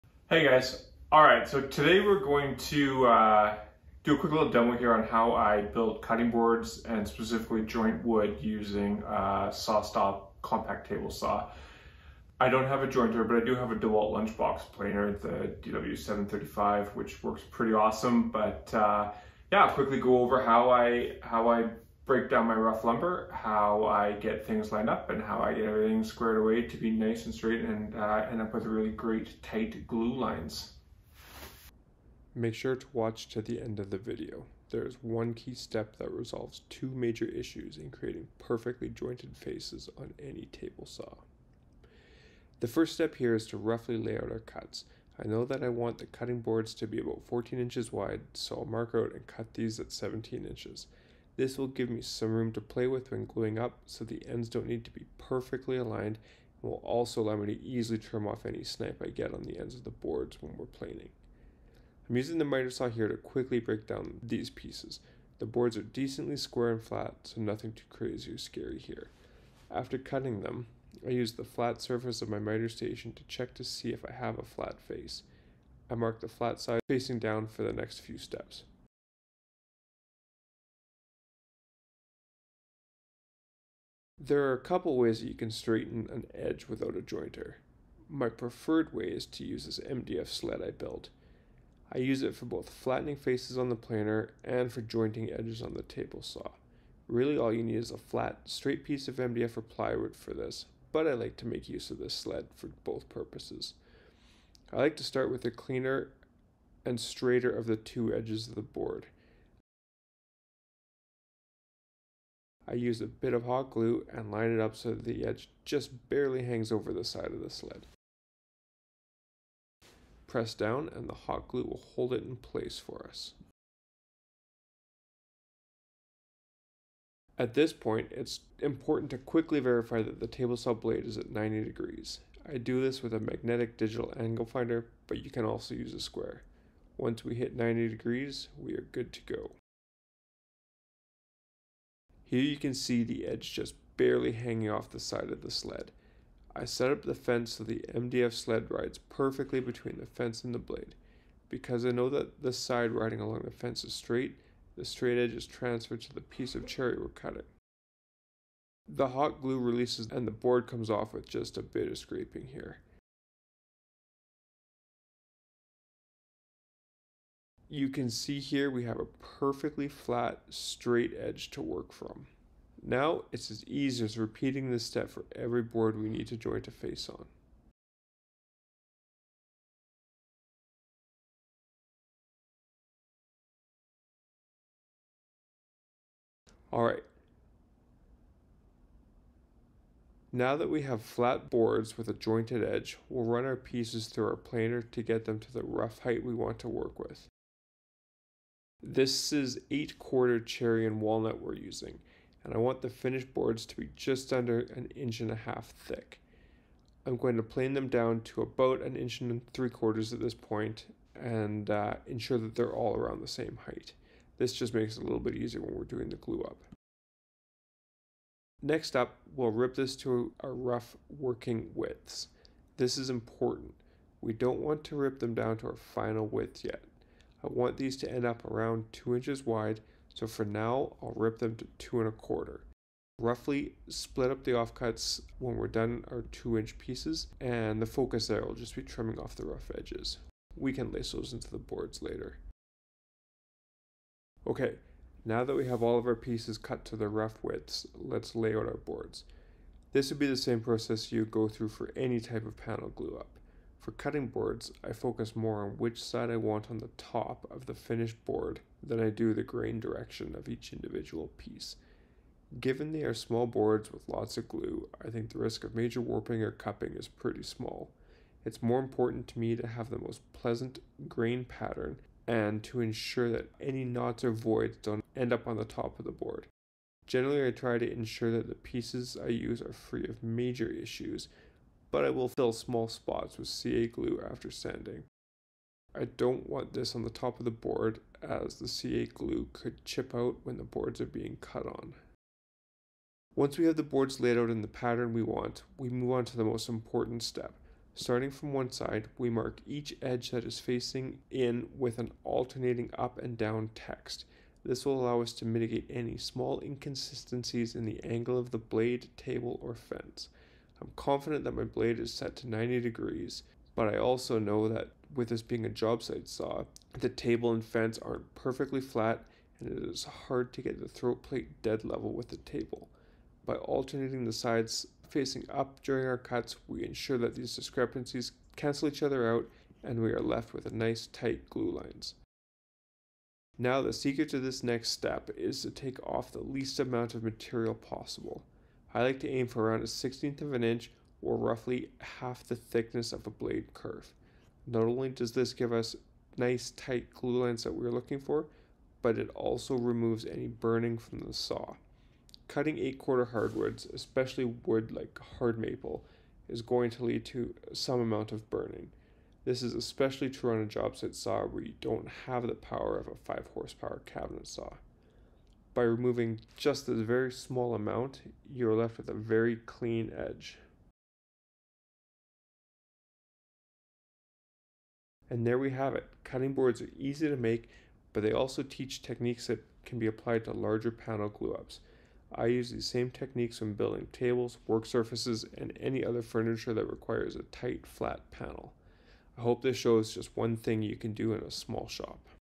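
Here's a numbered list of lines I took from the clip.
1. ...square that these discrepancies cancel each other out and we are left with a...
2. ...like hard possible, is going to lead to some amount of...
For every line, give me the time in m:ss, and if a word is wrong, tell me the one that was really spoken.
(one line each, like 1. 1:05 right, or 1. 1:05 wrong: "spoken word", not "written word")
1. 5:26 wrong: "ensure", not "square"
2. 5:54 wrong: "maple", not "possible".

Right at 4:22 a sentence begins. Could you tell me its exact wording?
Given they are small boards with lots of glue, I think the risk of major warping or cupping is pretty small.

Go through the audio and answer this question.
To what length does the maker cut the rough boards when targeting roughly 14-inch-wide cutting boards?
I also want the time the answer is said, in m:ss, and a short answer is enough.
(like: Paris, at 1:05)
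17 inches, at 0:49.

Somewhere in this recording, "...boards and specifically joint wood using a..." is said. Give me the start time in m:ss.
0:06.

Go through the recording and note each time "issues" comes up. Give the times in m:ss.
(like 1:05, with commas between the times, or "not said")
0:37, 4:40.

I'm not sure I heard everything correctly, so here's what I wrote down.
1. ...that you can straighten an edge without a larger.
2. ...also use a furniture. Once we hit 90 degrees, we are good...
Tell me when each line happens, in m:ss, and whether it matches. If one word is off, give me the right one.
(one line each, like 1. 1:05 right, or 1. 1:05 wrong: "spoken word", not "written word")
1. 1:25 wrong: "jointer", not "larger"
2. 2:15 wrong: "square", not "furniture".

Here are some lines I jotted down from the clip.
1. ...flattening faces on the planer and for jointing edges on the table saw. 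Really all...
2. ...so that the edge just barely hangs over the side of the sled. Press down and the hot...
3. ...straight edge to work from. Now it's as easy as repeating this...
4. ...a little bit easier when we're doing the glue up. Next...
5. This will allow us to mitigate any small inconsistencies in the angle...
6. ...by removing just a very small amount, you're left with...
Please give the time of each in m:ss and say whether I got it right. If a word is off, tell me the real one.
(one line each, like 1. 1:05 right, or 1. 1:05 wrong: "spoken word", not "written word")
1. 1:32 right
2. 1:54 right
3. 2:50 right
4. 3:35 right
5. 5:04 right
6. 6:05 right.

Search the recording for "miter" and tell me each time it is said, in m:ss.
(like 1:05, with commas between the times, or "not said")
1:02, 1:12.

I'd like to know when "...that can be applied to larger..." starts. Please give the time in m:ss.
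6:19.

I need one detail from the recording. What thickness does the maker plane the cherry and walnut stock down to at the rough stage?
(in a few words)
1 3/4 inches.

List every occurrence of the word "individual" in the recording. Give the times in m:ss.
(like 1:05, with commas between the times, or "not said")
4:20.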